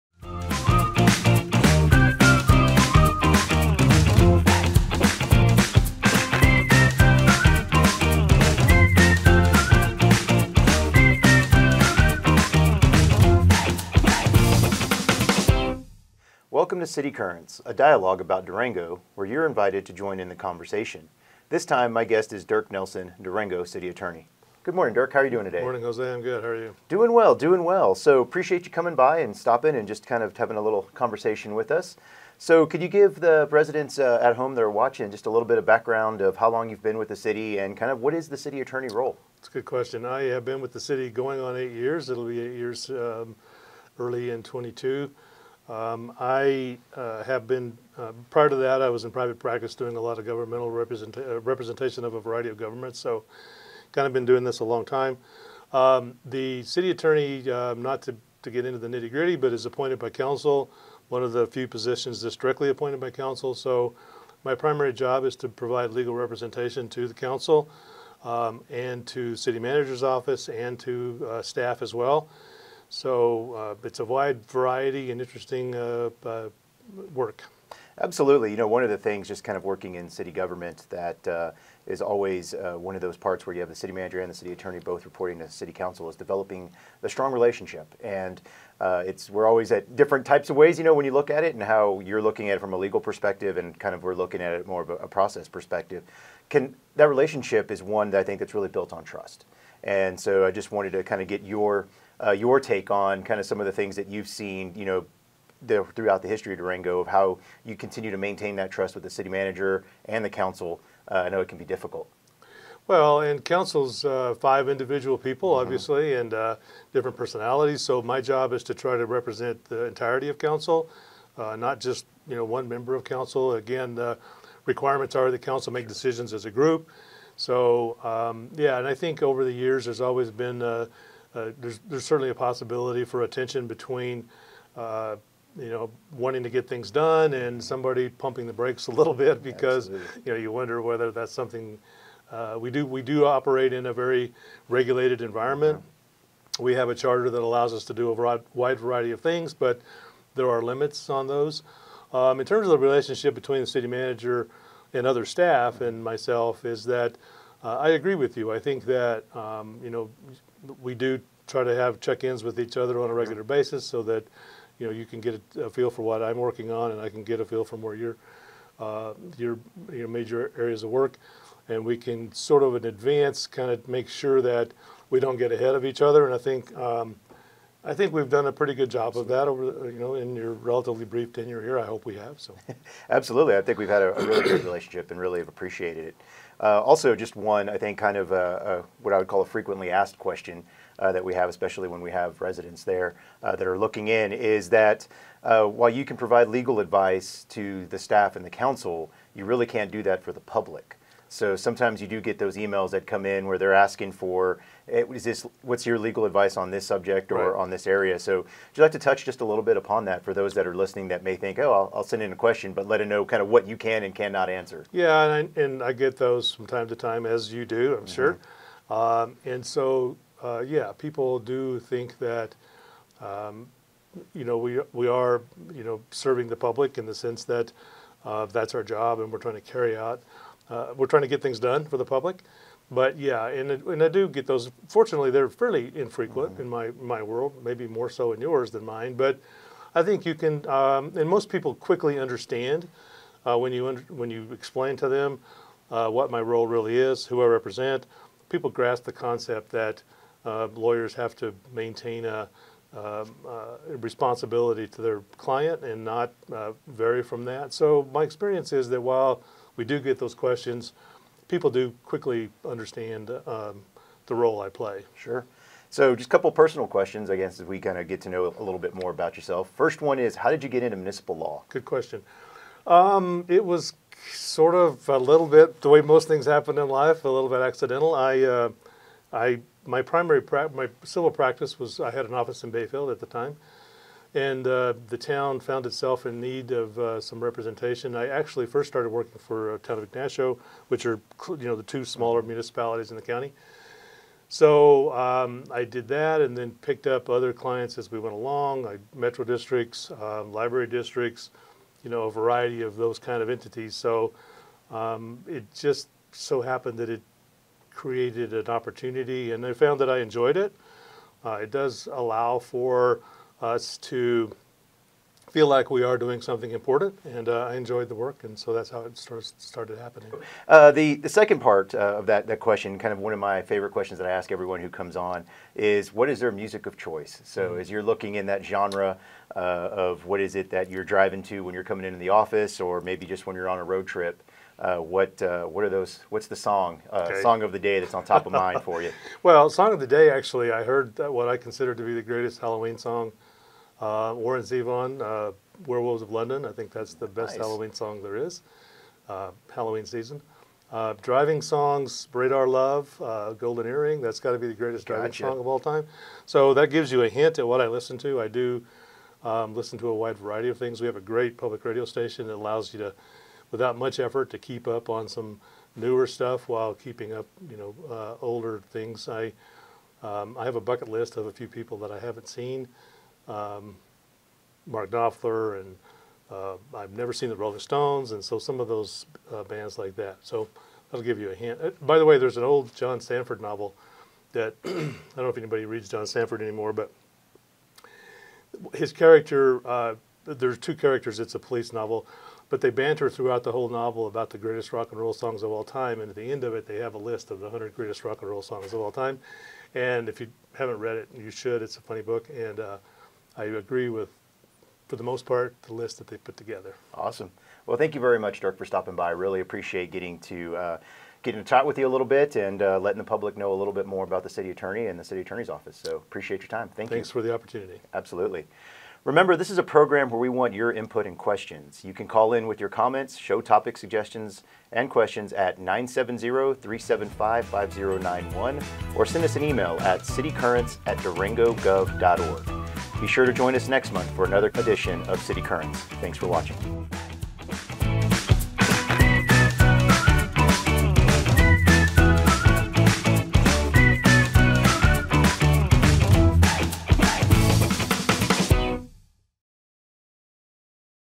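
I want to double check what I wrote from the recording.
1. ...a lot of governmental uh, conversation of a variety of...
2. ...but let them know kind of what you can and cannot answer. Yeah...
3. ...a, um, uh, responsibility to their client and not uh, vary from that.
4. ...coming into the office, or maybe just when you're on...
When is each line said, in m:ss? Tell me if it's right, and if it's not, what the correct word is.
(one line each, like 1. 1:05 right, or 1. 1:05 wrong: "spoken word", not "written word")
1. 0:49 wrong: "representation", not "conversation"
2. 3:32 right
3. 4:12 right
4. 5:31 right.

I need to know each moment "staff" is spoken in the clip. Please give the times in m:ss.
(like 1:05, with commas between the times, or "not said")
1:11, 2:35, 3:17.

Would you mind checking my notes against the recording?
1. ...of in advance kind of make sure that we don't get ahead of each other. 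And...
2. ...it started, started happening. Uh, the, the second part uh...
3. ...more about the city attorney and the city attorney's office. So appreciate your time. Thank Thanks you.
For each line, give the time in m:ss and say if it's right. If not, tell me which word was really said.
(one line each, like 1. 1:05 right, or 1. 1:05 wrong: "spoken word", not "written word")
1. 2:52 right
2. 5:19 right
3. 6:54 right.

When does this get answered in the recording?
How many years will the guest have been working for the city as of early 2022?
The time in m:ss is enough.
0:42.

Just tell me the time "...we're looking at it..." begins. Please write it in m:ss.
1:34.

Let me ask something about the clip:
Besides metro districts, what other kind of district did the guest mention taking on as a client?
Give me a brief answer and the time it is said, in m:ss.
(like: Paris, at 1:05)
Library districts, at 5:00.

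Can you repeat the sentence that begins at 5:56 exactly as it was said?
So that gives you a hint at what I listen to.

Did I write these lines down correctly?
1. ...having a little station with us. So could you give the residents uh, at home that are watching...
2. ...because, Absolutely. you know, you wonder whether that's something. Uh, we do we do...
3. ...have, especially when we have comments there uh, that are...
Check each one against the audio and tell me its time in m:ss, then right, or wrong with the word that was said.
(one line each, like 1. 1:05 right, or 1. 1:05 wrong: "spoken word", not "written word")
1. 0:30 wrong: "conversation", not "station"
2. 2:19 right
3. 3:11 wrong: "residents", not "comments".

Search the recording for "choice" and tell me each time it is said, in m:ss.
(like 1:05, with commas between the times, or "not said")
5:26.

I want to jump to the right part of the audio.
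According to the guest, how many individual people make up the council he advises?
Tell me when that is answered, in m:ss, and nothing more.
1:54.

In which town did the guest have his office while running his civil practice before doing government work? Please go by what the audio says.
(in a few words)
Bayfield.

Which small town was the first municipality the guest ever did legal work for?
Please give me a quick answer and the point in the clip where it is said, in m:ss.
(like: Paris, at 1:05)
Ignacio, at 4:50.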